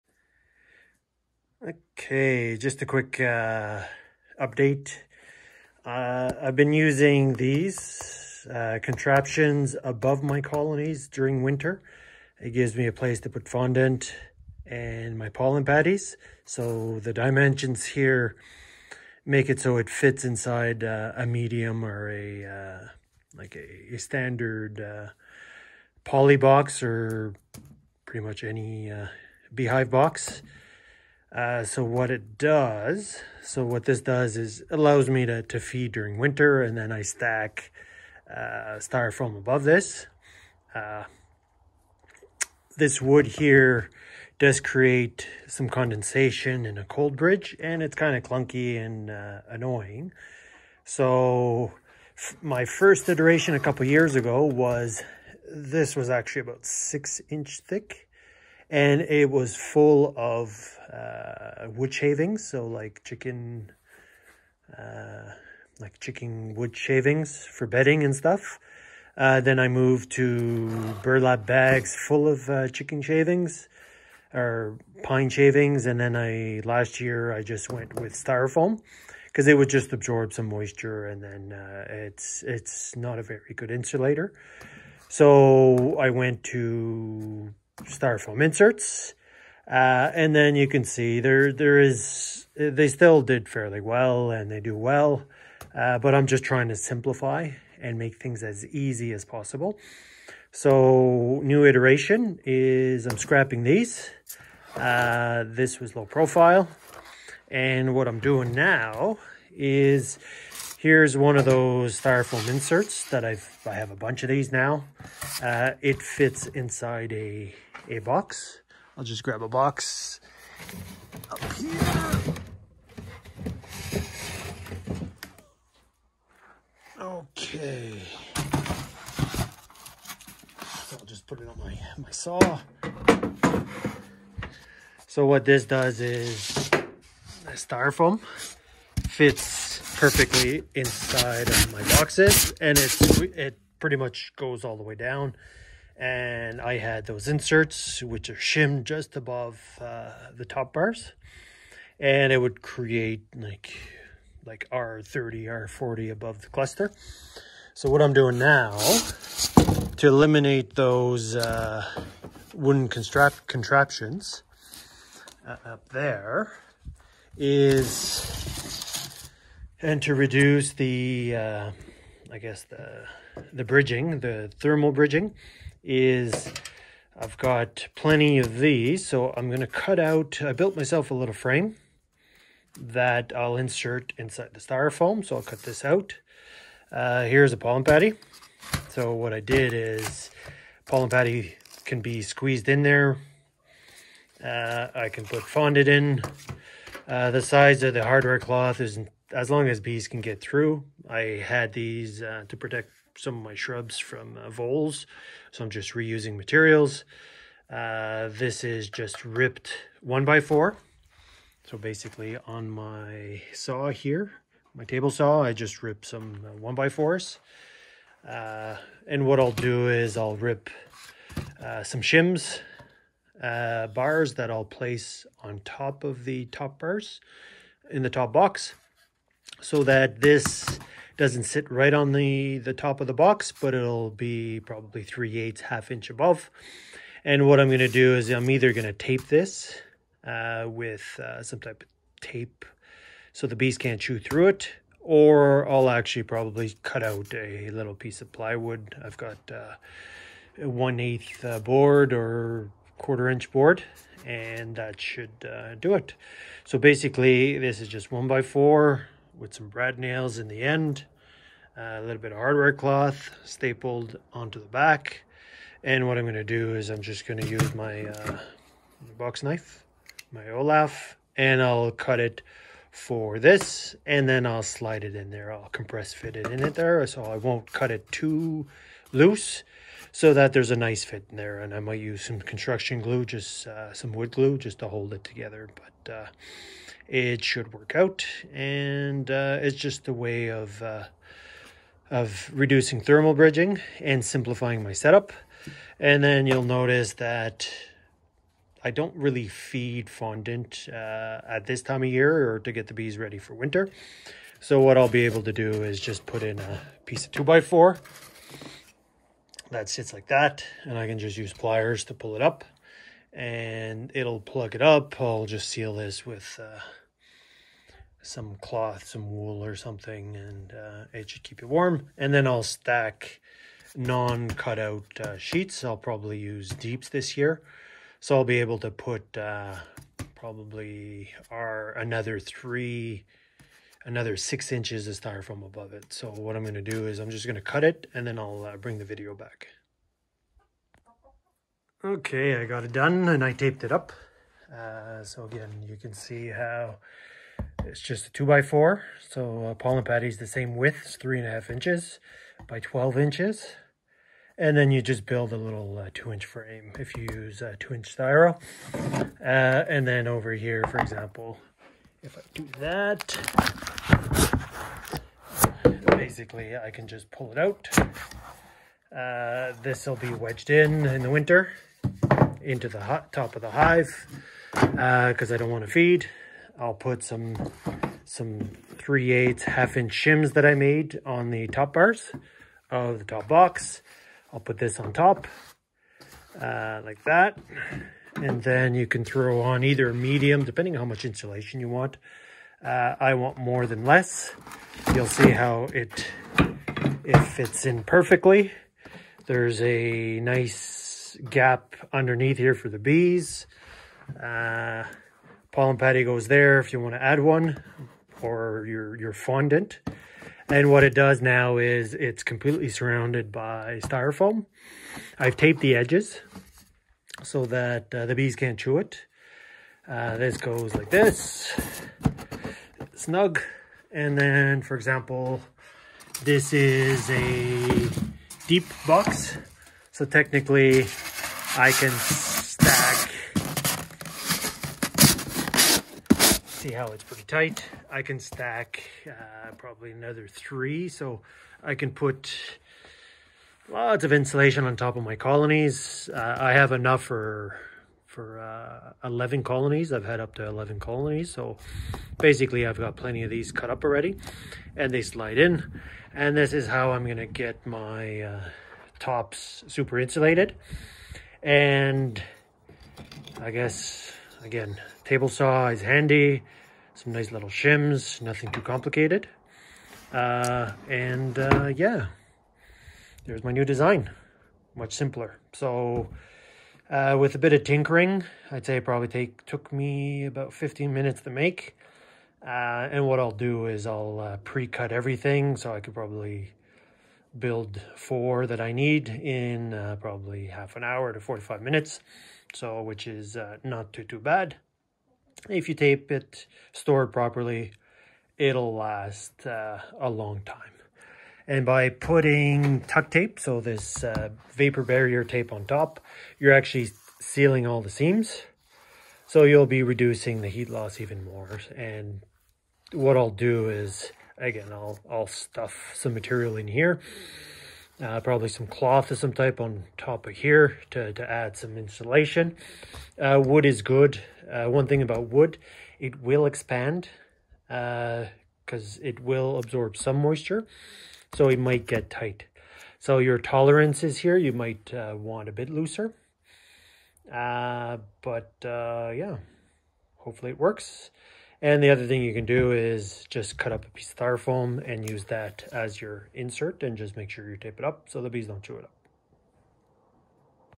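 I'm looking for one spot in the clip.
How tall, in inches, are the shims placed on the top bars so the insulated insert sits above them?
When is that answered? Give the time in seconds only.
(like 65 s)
378 s.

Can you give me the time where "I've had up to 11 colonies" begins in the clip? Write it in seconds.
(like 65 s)
450 s.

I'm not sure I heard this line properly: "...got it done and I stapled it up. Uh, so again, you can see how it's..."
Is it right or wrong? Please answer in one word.
wrong.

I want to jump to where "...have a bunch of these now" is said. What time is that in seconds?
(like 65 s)
113 s.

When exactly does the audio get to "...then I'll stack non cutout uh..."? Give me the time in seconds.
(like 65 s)
322 s.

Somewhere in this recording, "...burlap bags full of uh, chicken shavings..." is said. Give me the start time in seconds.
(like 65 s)
71 s.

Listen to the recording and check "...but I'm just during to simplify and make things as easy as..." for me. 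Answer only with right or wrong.
wrong.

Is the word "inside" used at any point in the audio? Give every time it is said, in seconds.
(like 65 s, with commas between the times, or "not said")
20 s, 116 s, 140 s, 184 s.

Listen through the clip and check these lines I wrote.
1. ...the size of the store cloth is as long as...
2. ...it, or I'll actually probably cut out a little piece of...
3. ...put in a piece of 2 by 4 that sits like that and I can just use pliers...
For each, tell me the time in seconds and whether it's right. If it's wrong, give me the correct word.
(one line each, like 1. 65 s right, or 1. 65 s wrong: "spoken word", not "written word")
1. 197 s wrong: "hardware", not "store"
2. 244 s right
3. 306 s right.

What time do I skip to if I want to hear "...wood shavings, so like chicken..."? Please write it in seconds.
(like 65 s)
61 s.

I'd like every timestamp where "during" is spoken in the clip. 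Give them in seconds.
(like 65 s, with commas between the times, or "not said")
11 s, 35 s.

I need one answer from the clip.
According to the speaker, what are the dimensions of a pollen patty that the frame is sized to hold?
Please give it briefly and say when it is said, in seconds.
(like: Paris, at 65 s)
3.5 by 12 inches, at 351 s.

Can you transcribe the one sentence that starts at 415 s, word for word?
I've taped the edges so that uh, the bees can't chew it.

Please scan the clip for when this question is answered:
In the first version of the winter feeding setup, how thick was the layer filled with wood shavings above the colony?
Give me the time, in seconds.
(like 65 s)
56 s.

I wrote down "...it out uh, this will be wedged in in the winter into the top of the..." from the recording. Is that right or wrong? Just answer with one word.
right.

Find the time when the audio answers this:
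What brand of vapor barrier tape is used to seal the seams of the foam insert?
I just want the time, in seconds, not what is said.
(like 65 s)
503 s.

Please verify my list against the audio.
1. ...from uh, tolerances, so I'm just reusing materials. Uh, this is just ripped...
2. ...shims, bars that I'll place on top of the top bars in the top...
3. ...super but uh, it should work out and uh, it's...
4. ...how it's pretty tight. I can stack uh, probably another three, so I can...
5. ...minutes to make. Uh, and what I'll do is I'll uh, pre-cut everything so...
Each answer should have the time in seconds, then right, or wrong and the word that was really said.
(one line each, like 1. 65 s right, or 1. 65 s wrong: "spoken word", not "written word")
1. 203 s wrong: "voles", not "tolerances"
2. 222 s right
3. 285 s wrong: "together", not "super"
4. 436 s right
5. 481 s right.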